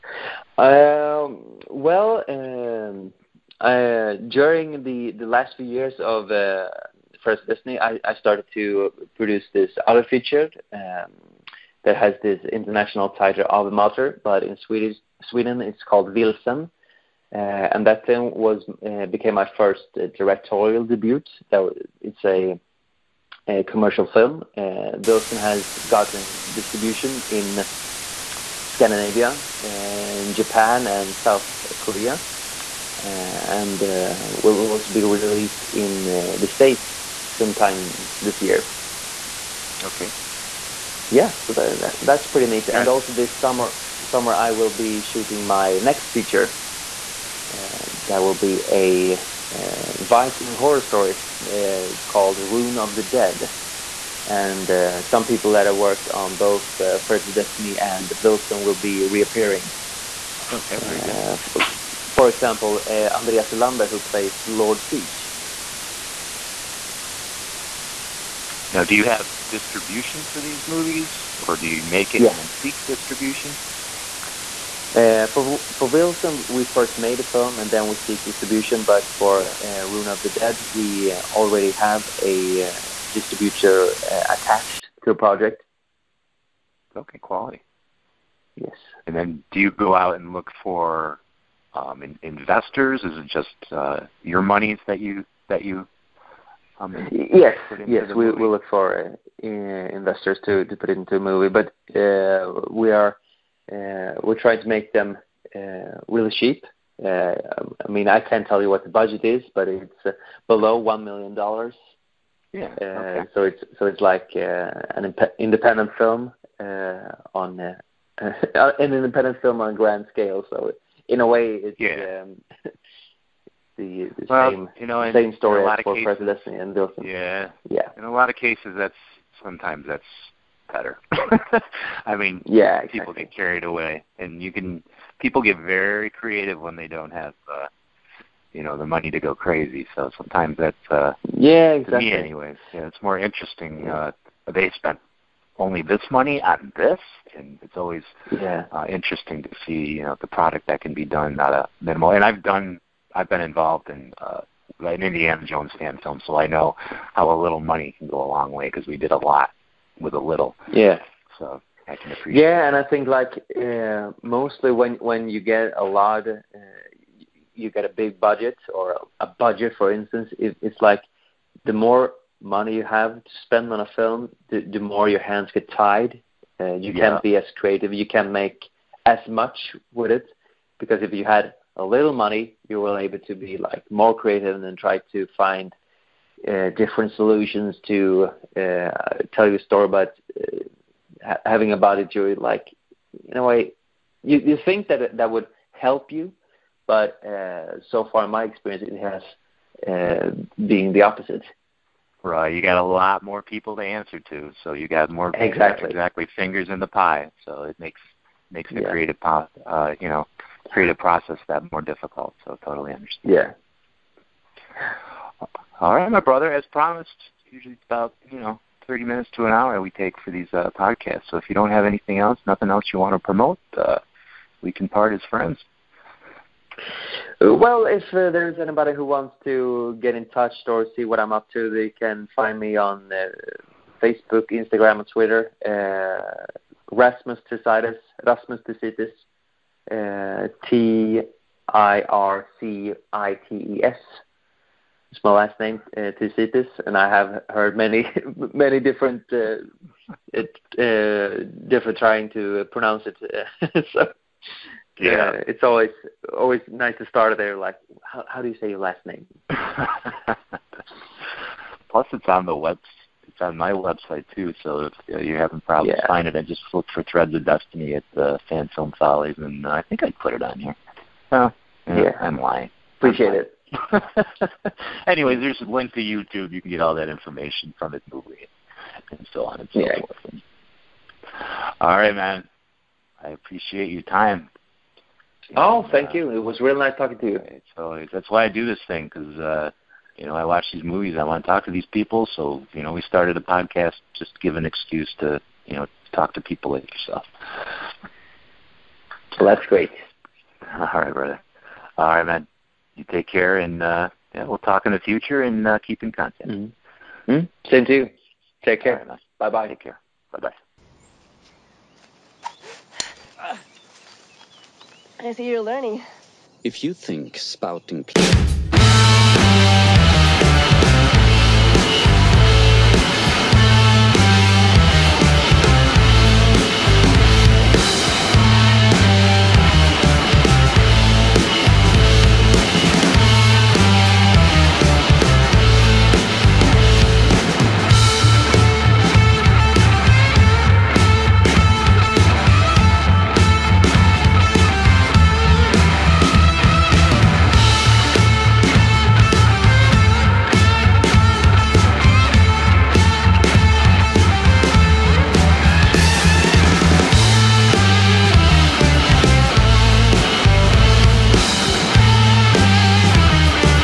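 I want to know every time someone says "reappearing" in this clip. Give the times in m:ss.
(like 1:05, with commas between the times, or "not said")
0:59.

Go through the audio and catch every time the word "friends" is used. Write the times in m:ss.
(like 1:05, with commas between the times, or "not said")
3:45.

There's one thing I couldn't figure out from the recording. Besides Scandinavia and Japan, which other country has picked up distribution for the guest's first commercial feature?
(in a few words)
South Korea.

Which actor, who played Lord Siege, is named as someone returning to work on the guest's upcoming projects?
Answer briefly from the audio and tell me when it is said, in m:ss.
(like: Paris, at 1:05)
Andreas Ulander, at 1:03.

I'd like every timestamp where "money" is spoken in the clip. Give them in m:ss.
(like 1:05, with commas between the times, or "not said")
2:18, 2:26, 2:37, 2:52, 3:02.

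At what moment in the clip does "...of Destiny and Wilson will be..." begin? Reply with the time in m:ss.
0:57.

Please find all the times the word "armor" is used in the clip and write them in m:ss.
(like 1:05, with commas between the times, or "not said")
not said.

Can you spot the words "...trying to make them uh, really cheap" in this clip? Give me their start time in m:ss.
1:44.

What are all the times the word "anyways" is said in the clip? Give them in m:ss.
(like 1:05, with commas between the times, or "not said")
2:22, 4:35.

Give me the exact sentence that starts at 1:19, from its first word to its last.
uh, Rune of the Dead, we already have a uh, distributor uh, attached to a project.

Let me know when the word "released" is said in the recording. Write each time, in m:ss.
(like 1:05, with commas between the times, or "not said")
0:35.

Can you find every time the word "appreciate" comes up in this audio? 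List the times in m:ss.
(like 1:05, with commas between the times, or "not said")
2:42, 4:32, 4:43.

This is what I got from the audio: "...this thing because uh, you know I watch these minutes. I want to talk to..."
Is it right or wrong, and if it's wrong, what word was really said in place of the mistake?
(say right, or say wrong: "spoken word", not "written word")
wrong: "movies", not "minutes".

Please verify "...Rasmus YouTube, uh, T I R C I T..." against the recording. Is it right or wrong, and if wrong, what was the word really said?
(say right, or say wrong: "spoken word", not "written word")
wrong: "Tirzitis", not "YouTube".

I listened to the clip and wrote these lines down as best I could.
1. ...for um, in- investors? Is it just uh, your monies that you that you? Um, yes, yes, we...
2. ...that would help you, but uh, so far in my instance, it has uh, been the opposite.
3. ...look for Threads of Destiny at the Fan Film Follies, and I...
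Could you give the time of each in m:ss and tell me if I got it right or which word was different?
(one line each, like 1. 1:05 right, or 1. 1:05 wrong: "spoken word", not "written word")
1. 1:30 right
2. 3:15 wrong: "experience", not "instance"
3. 4:26 right.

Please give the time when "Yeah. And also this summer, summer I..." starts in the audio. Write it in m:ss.
0:42.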